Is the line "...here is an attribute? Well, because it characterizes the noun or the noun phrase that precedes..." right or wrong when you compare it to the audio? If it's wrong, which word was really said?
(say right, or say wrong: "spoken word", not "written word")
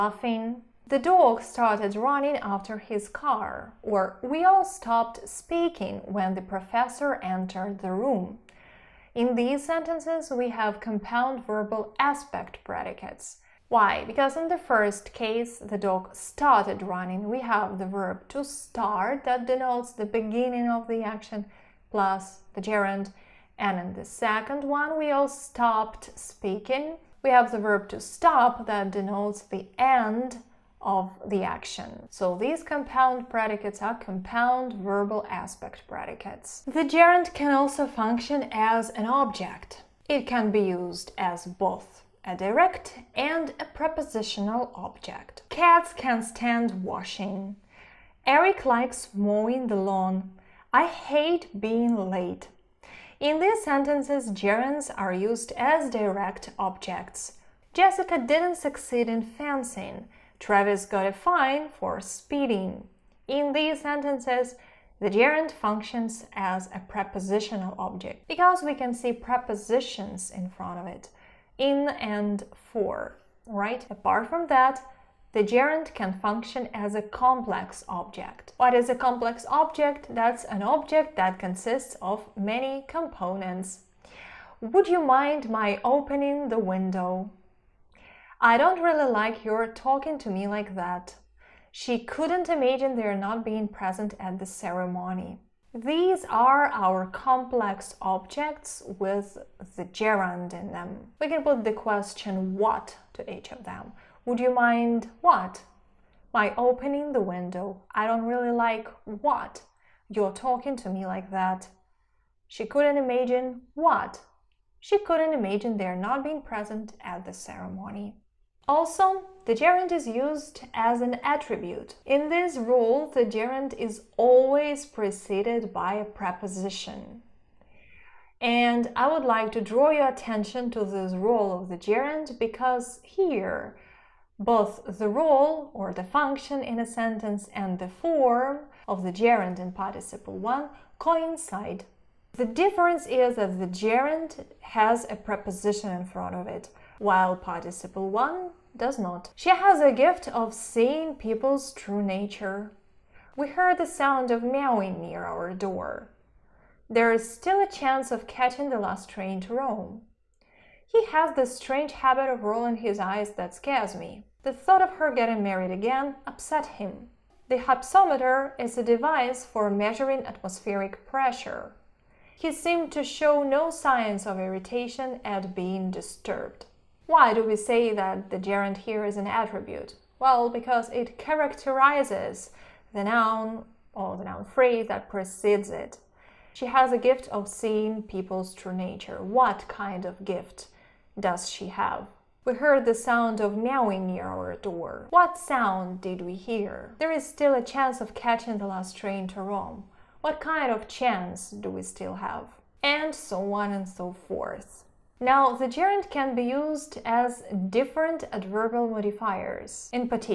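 right.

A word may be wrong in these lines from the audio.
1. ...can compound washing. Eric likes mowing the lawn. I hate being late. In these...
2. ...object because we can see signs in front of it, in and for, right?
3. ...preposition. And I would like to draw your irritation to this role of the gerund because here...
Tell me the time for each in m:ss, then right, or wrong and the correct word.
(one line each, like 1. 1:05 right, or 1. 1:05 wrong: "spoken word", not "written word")
1. 0:45 wrong: "stand", not "compound"
2. 1:07 wrong: "prepositions", not "signs"
3. 2:06 wrong: "attention", not "irritation".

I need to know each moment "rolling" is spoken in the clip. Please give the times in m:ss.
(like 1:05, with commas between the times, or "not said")
2:42.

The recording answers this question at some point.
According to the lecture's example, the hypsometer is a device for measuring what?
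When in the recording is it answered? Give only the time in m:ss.
2:50.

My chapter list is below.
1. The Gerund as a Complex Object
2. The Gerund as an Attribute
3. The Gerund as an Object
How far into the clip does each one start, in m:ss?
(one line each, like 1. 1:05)
1. 1:14
2. 1:58
3. 0:36.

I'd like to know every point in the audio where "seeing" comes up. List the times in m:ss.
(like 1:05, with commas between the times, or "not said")
2:30, 3:07.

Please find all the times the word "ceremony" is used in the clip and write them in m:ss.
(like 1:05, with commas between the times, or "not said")
1:34, 1:57.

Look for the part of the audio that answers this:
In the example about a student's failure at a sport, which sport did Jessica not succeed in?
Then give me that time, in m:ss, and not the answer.
0:59.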